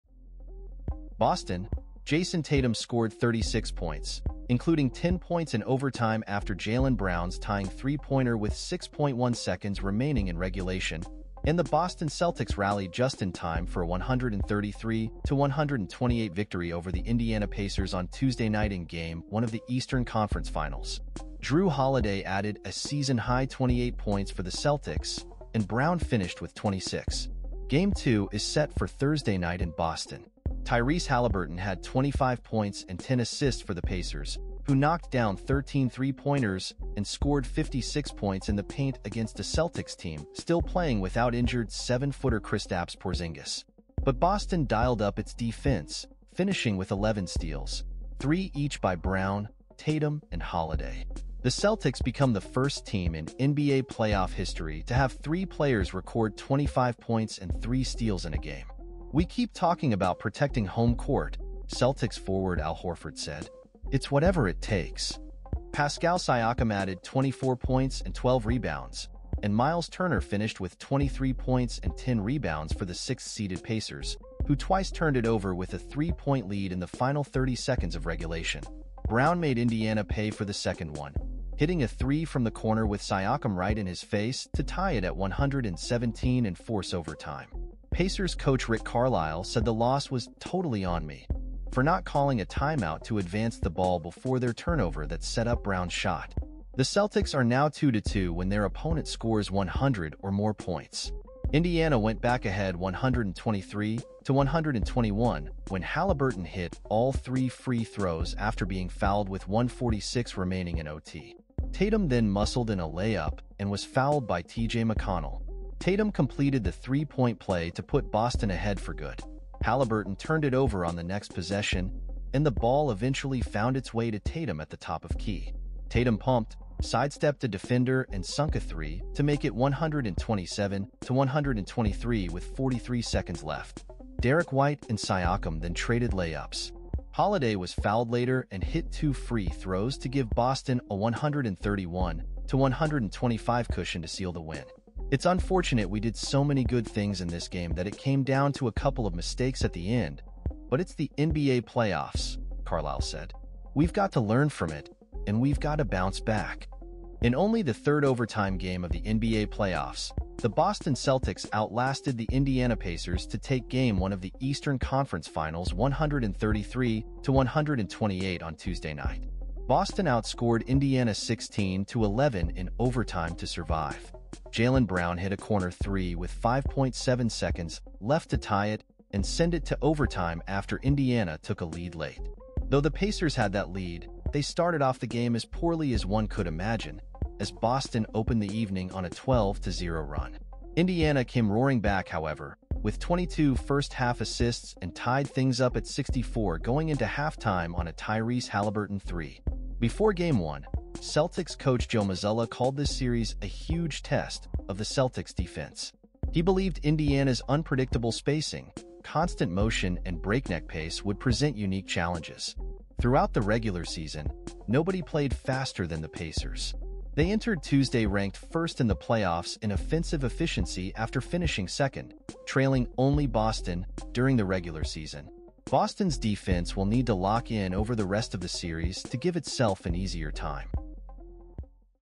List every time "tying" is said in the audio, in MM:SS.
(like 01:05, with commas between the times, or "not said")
00:07.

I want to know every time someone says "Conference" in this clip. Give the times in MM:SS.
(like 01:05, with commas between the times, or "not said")
00:20, 02:44.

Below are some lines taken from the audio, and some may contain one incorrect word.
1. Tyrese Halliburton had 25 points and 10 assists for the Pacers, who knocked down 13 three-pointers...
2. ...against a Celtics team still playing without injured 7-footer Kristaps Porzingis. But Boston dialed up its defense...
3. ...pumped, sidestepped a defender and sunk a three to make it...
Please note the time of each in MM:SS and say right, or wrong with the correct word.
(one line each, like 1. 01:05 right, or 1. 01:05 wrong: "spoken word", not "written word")
1. 00:30 right
2. 00:39 right
3. 02:06 right.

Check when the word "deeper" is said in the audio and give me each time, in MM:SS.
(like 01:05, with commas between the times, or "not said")
not said.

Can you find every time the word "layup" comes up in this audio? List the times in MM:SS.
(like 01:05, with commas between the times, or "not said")
01:52, 02:16.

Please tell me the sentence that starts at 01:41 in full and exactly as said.
Indiana went back ahead 123 to 121 when Halliburton hit all three free throws after being fouled with 146 remaining in OT.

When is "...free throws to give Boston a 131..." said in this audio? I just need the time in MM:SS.
02:19.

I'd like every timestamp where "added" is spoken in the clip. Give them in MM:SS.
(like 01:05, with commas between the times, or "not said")
00:22, 01:06.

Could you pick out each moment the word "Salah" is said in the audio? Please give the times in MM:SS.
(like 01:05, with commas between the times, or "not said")
not said.